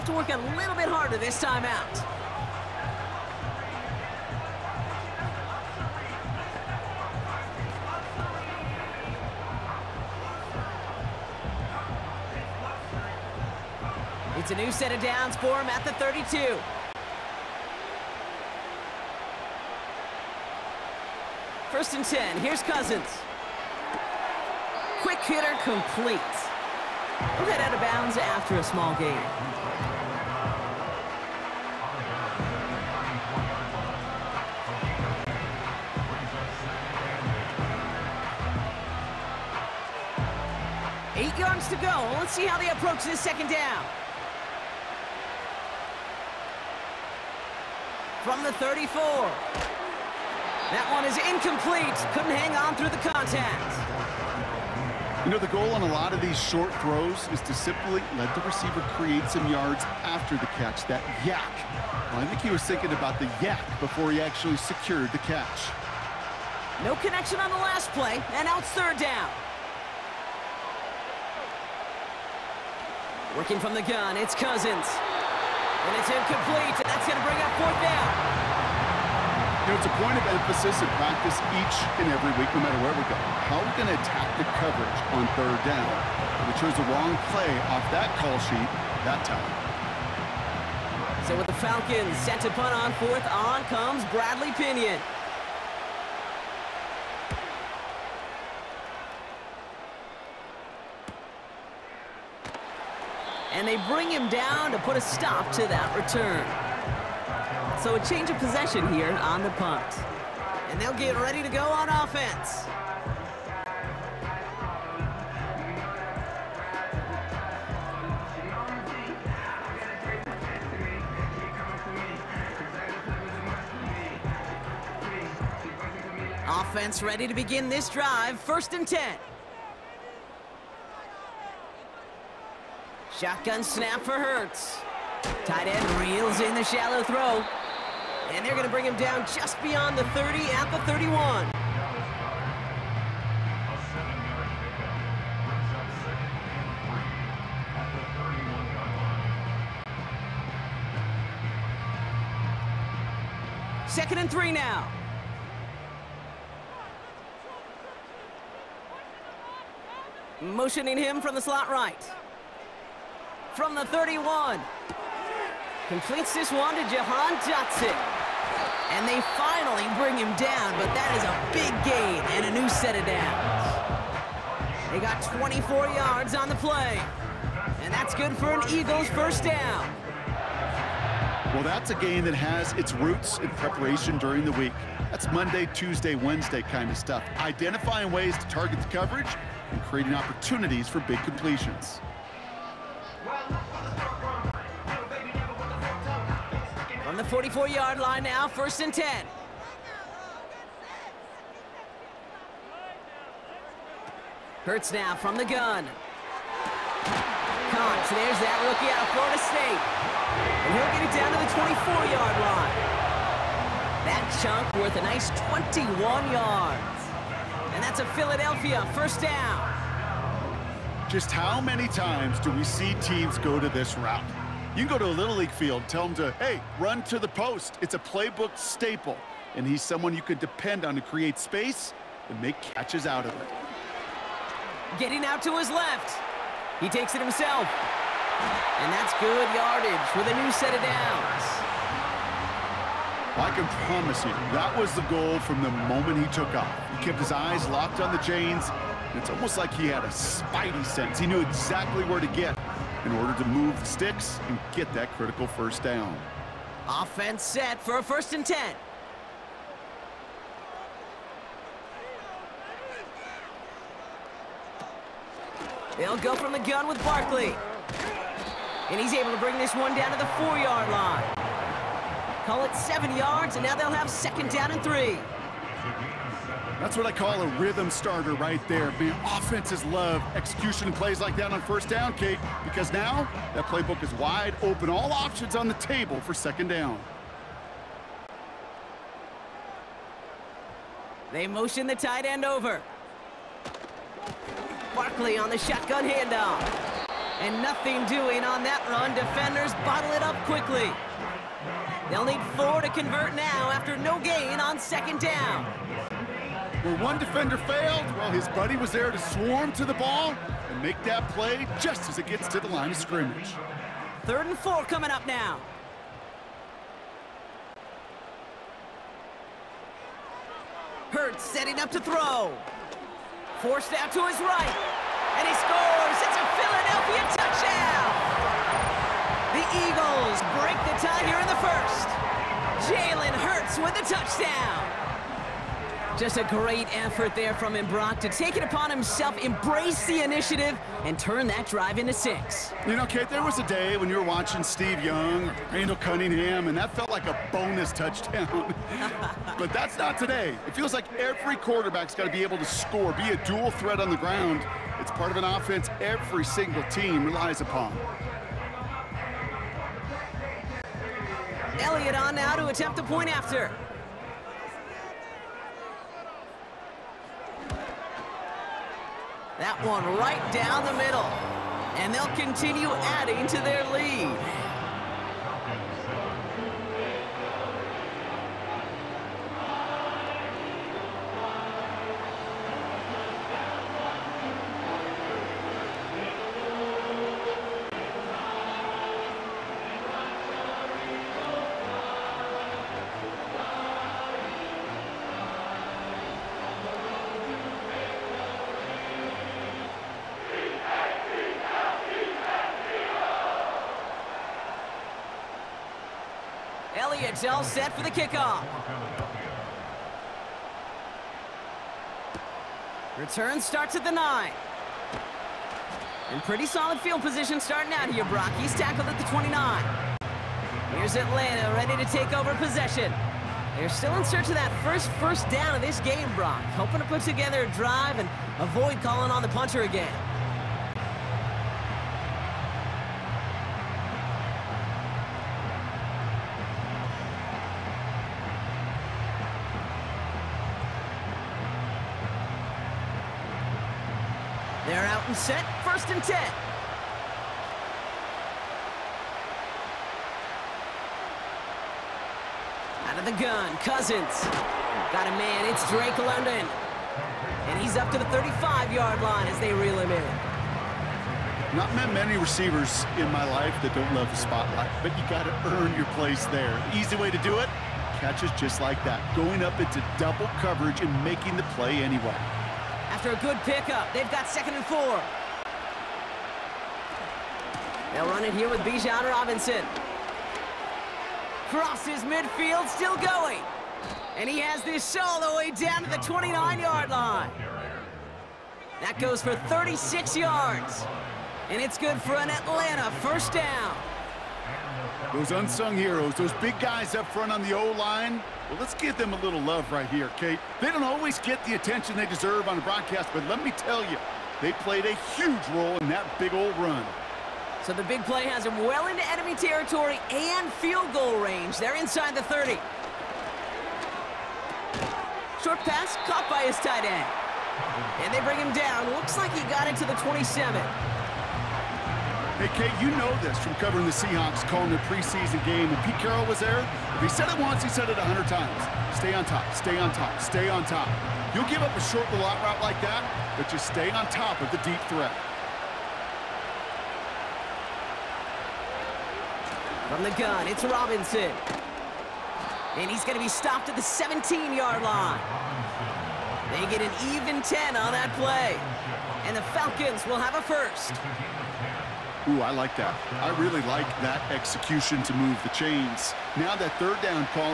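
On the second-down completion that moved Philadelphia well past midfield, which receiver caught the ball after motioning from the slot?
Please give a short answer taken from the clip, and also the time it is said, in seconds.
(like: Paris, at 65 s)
Jahan Dotson, at 166 s.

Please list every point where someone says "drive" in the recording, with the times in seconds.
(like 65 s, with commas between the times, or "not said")
127 s, 341 s, 427 s.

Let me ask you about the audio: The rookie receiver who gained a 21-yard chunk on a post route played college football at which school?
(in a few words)
Florida State.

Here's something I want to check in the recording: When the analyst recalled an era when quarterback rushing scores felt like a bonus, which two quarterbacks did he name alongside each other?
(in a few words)
Steve Young, Randall Cunningham.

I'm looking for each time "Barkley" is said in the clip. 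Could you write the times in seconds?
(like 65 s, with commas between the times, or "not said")
267 s, 294 s.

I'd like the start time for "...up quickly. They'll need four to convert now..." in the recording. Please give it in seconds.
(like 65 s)
300 s.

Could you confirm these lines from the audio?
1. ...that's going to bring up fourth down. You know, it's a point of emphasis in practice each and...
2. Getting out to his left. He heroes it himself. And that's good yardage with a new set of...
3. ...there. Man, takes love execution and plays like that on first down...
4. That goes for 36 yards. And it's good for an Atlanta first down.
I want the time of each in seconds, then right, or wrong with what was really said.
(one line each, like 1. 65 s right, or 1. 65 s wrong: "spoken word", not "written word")
1. 76 s right
2. 234 s wrong: "takes", not "heroes"
3. 278 s wrong: "offenses", not "takes"
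4. 489 s right.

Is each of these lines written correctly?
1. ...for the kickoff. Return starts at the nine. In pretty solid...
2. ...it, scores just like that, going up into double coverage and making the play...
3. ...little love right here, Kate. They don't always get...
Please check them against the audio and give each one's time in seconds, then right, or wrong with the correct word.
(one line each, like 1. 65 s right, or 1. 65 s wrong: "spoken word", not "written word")
1. 407 s right
2. 467 s wrong: "catches", not "scores"
3. 499 s right.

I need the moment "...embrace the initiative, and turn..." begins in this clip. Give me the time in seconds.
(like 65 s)
339 s.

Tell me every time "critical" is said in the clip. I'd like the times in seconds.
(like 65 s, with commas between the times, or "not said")
255 s.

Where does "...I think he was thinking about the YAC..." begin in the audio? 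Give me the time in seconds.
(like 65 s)
62 s.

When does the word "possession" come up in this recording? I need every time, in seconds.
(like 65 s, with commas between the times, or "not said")
108 s, 422 s.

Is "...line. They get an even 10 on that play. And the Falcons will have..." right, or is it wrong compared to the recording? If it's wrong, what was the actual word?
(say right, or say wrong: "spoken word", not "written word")
right.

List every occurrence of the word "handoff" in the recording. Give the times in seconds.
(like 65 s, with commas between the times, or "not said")
296 s.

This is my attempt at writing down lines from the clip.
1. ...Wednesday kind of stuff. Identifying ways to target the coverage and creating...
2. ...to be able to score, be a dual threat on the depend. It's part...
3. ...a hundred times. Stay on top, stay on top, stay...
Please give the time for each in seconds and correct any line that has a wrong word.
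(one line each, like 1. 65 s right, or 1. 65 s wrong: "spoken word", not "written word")
1. 186 s right
2. 352 s wrong: "ground", not "depend"
3. 528 s right.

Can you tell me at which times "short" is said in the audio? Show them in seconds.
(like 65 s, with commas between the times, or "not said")
56 s, 515 s, 531 s.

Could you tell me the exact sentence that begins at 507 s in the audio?
So the big play has them well into enemy territory and field goal range.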